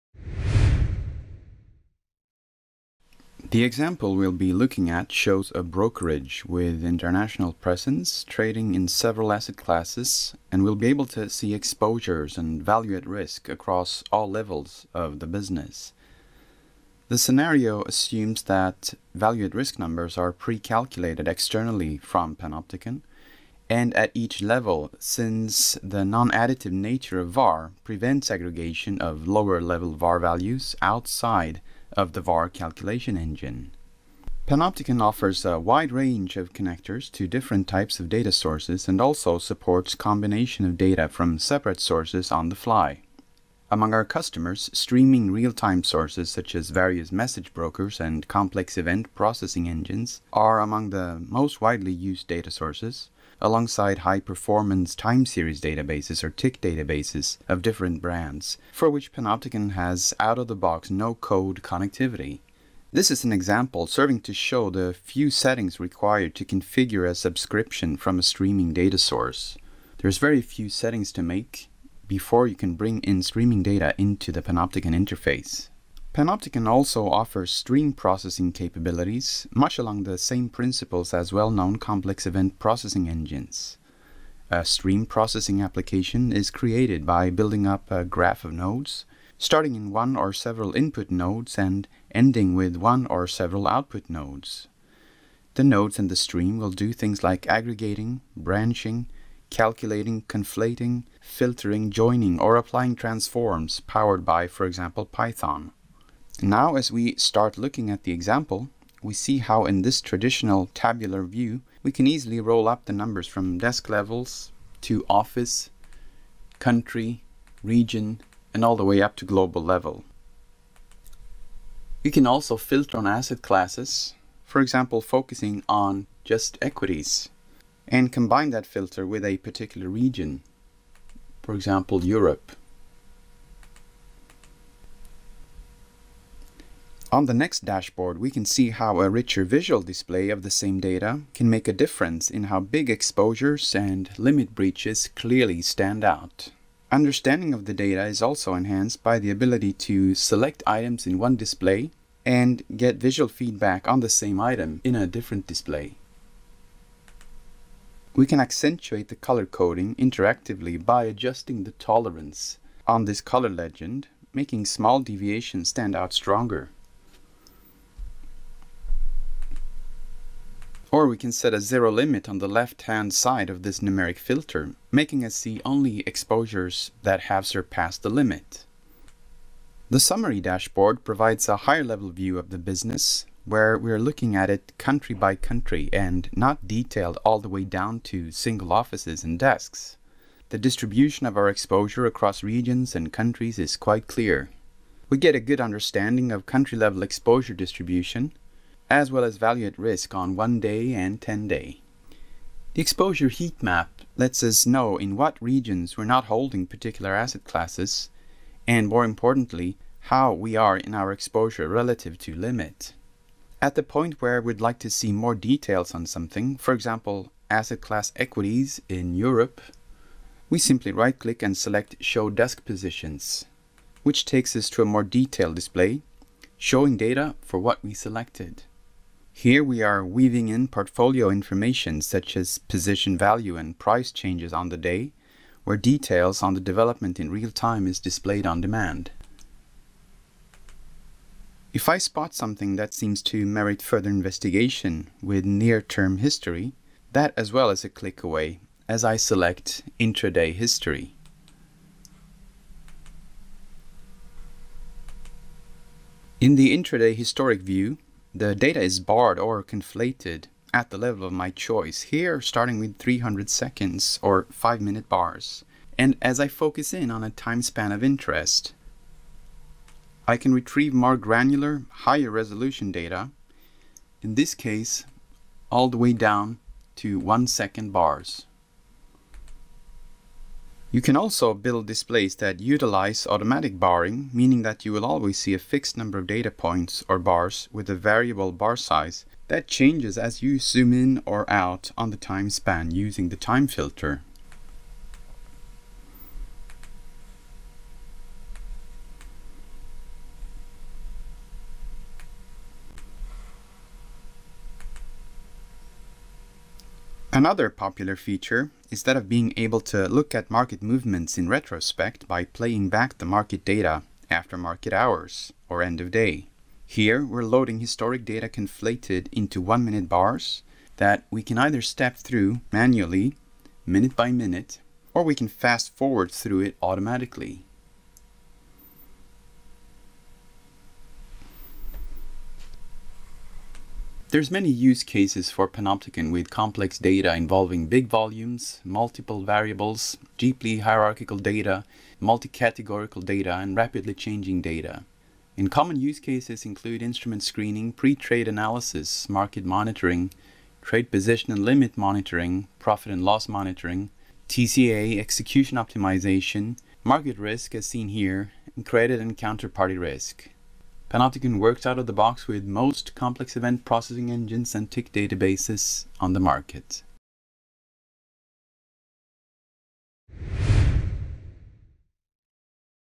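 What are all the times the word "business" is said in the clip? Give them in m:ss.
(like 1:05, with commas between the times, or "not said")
0:15, 3:02.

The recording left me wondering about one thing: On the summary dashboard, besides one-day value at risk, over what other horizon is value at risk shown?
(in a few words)
10 day.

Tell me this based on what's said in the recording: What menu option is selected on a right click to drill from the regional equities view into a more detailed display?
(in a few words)
Show Desk Positions.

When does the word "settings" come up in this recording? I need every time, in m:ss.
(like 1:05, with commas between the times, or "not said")
1:05, 1:10.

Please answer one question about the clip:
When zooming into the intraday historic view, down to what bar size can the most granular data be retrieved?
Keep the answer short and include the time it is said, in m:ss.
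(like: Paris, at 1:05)
1 second, at 4:37.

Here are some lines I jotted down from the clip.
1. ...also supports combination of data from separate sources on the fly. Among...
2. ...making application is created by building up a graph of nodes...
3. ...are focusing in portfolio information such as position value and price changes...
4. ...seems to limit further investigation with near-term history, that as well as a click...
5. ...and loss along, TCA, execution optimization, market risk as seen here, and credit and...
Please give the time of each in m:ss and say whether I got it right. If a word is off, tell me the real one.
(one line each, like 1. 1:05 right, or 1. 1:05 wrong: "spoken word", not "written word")
1. 0:38 right
2. 1:25 wrong: "processing", not "making"
3. 3:49 wrong: "weaving", not "focusing"
4. 4:02 wrong: "merit", not "limit"
5. 5:53 wrong: "monitoring", not "along".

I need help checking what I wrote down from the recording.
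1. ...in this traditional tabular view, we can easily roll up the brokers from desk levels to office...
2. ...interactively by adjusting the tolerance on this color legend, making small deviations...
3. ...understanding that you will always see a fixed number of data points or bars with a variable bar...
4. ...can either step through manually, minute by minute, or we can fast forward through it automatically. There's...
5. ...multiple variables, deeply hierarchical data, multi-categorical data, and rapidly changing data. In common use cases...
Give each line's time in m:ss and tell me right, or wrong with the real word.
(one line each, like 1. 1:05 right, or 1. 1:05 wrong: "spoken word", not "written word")
1. 1:49 wrong: "numbers", not "brokers"
2. 2:39 right
3. 4:44 wrong: "meaning", not "understanding"
4. 5:21 right
5. 5:38 right.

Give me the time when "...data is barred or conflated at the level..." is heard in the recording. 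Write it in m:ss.
4:18.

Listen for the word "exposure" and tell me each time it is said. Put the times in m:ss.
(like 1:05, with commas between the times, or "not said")
0:11, 2:22, 2:56, 3:11, 3:17, 3:22, 3:31.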